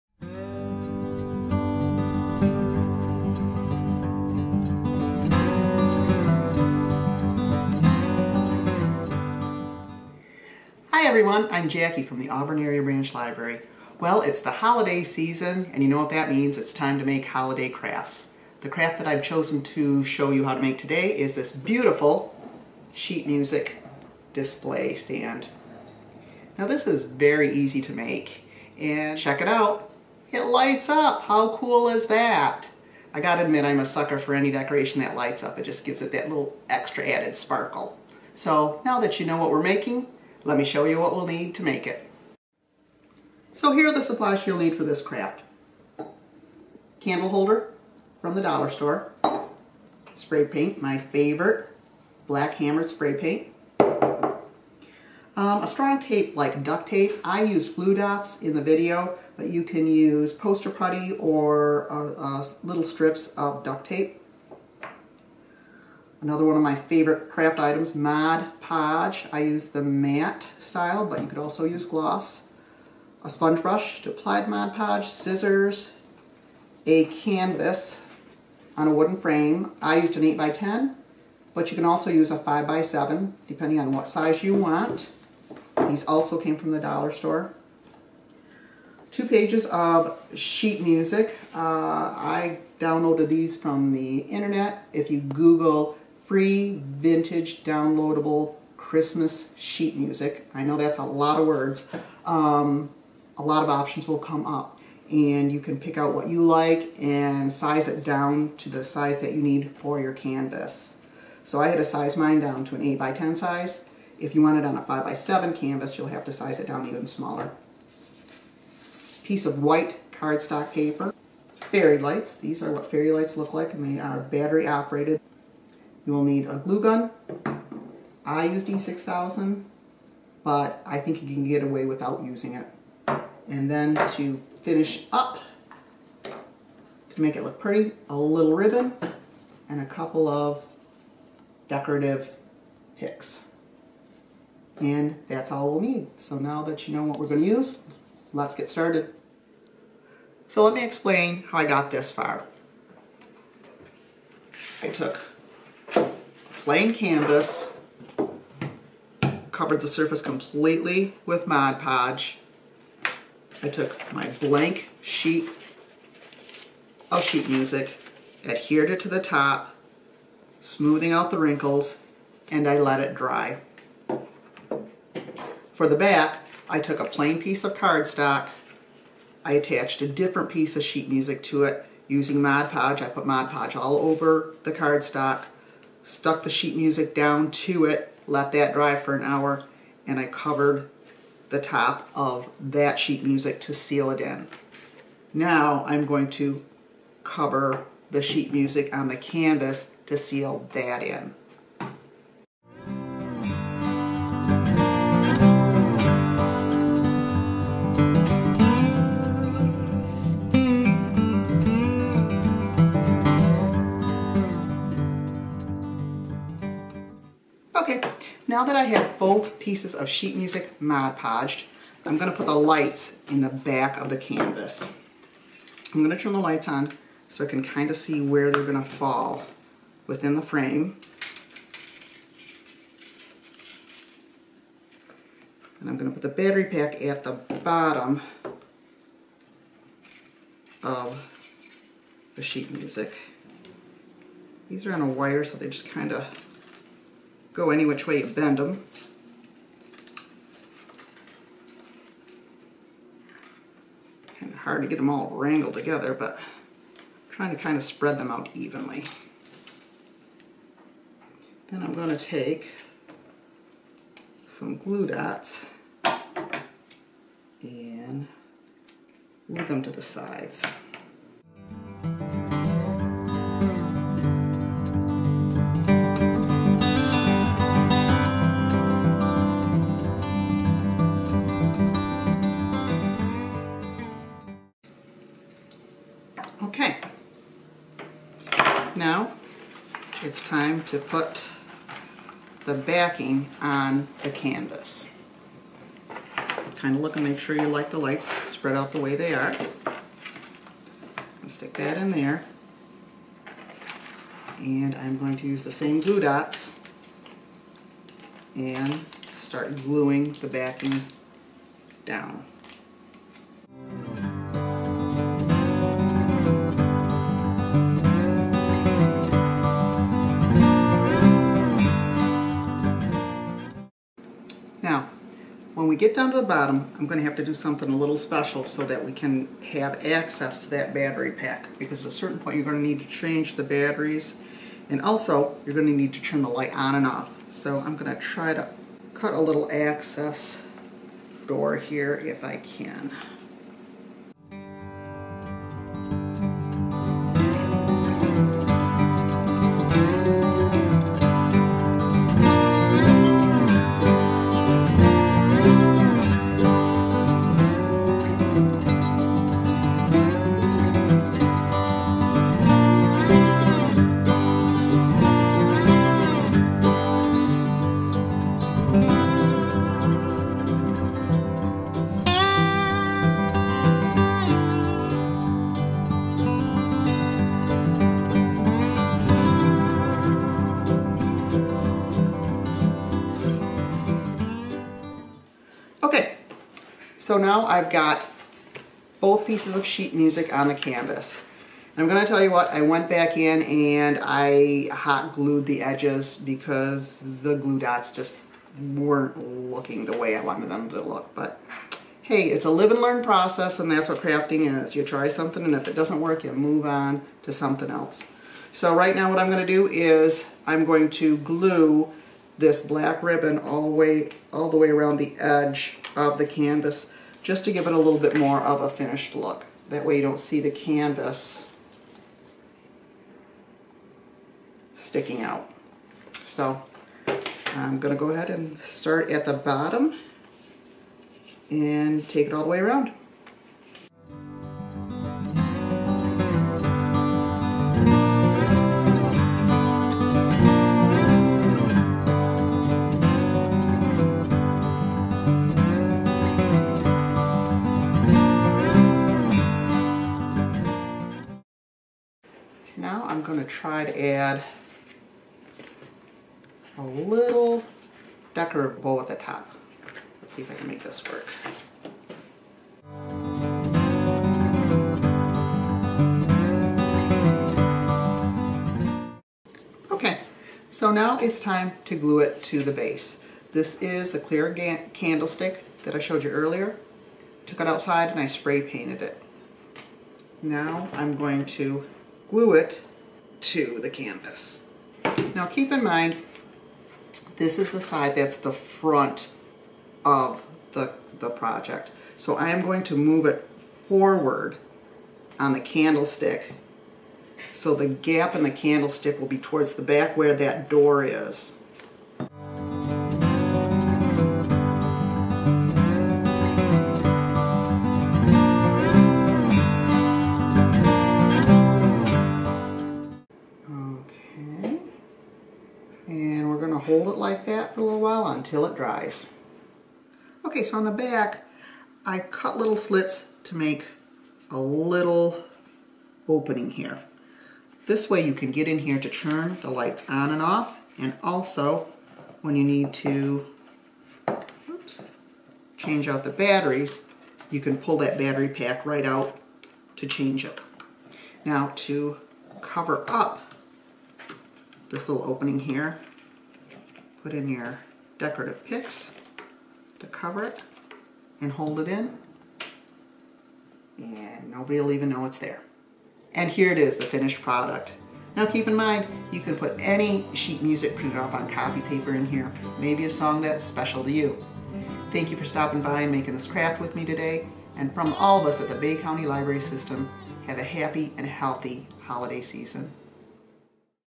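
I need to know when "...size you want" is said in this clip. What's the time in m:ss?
1:24.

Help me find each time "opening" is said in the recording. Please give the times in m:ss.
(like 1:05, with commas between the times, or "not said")
8:46, 9:05.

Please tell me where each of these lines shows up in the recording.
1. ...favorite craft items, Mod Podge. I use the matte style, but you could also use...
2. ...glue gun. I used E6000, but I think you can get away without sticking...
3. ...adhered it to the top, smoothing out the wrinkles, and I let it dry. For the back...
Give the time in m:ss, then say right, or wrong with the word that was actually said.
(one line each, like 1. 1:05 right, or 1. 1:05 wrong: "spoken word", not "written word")
1. 1:06 right
2. 2:06 wrong: "using", not "sticking"
3. 2:48 right.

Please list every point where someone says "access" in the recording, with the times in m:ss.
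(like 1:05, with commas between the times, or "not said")
5:30, 5:39.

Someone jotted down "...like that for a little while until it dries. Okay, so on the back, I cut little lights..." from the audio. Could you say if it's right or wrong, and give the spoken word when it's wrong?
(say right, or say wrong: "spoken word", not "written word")
wrong: "slits", not "lights".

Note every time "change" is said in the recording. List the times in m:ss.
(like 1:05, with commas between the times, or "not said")
5:33, 8:55, 9:00.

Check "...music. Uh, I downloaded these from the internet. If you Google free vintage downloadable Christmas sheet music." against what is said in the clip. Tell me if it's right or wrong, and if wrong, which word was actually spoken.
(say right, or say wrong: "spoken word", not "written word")
right.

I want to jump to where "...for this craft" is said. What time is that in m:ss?
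0:44.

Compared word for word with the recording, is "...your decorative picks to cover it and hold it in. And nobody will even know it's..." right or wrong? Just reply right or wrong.
right.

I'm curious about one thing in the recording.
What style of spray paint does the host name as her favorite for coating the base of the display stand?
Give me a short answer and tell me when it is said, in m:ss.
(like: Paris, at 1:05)
Black hammered, at 0:52.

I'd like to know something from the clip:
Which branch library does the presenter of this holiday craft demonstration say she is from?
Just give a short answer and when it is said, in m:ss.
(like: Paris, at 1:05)
Auburn Area Branch Library, at 0:12.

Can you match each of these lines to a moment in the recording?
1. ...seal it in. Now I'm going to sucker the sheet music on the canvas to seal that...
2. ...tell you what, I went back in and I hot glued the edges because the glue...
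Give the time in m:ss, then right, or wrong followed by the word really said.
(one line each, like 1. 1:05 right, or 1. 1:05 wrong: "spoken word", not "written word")
1. 3:13 wrong: "cover", not "sucker"
2. 6:32 right.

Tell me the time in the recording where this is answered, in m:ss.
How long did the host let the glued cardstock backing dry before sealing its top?
3:09.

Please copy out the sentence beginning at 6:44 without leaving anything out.
You try something and if it doesn't work, you move on to something else.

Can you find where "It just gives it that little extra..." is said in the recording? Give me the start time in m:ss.
0:35.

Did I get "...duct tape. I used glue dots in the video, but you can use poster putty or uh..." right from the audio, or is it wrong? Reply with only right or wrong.
right.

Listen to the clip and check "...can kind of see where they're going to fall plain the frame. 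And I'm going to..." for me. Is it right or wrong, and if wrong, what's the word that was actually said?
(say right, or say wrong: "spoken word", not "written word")
wrong: "within", not "plain".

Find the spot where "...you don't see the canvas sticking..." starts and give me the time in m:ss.
7:00.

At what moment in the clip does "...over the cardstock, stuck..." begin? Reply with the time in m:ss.
3:03.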